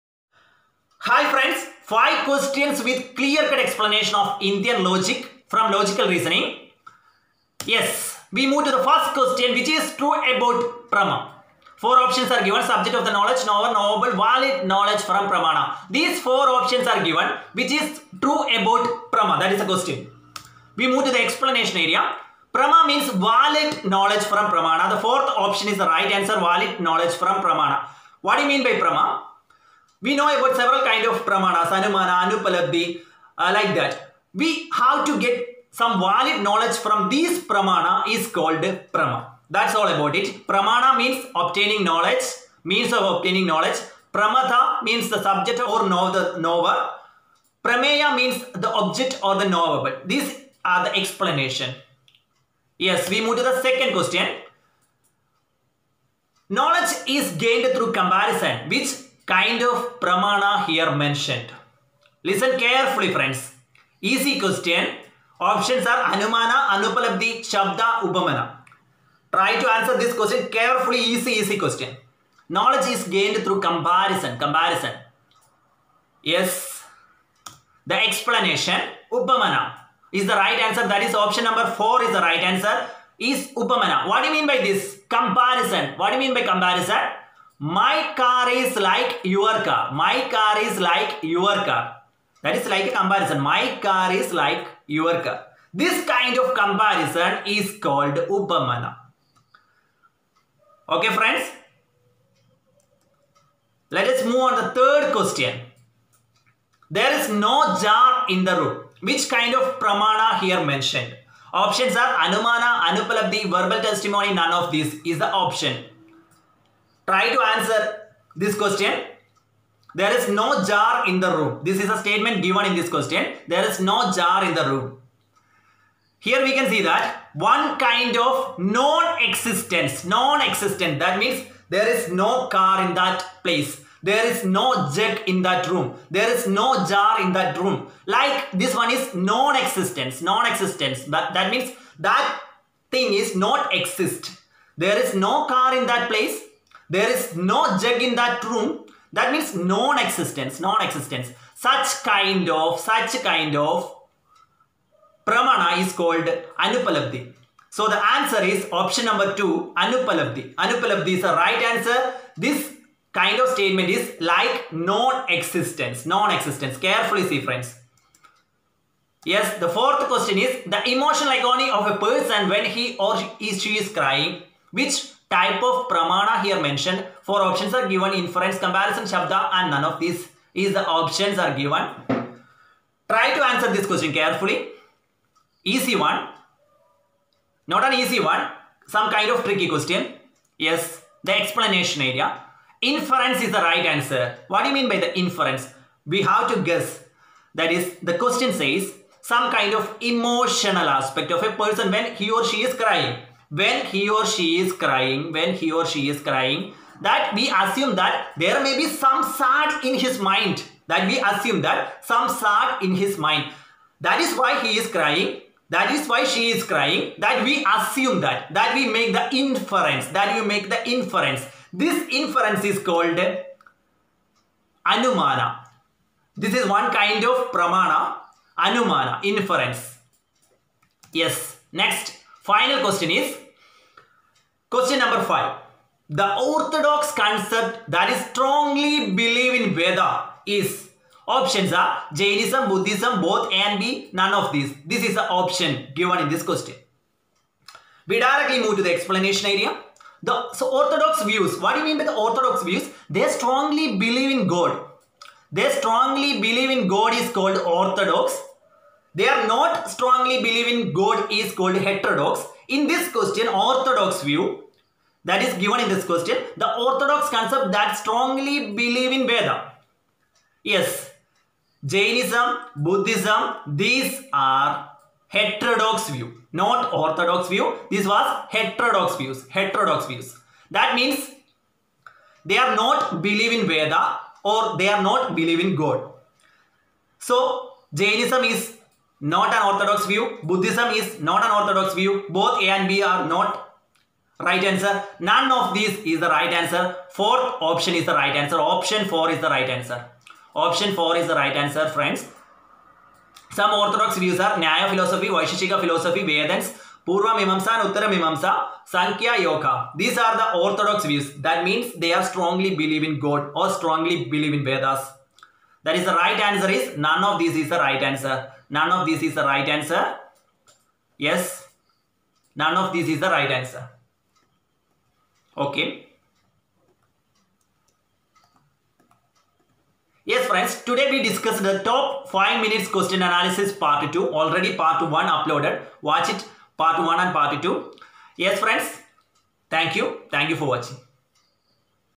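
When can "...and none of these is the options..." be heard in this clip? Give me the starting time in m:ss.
2:59.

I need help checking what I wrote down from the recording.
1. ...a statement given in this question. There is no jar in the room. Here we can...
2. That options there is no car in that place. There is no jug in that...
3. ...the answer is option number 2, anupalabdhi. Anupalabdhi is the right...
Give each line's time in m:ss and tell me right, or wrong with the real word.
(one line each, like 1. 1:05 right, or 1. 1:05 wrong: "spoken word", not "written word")
1. 2:01 right
2. 2:10 wrong: "means", not "options"
3. 2:37 right.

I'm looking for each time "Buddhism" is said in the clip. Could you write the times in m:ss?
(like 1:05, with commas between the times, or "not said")
4:02, 4:32, 4:50.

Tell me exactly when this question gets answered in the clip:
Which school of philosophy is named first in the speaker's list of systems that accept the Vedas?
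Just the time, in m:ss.
5:04.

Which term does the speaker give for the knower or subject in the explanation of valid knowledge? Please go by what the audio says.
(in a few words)
Pramatha.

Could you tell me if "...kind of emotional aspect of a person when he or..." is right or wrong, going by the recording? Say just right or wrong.
right.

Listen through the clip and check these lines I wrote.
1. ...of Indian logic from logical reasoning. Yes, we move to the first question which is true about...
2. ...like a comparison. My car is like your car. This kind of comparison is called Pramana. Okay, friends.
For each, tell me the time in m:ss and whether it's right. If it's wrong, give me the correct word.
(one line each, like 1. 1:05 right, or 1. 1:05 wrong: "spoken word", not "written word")
1. 0:04 right
2. 1:32 wrong: "Upamana", not "Pramana".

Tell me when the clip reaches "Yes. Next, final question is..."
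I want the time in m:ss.
3:51.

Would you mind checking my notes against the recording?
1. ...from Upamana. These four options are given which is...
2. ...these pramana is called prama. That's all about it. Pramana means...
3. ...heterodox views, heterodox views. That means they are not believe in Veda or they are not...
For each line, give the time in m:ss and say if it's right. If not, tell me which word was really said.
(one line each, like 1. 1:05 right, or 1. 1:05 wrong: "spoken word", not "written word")
1. 0:15 wrong: "Pramana", not "Upamana"
2. 0:37 right
3. 4:38 right.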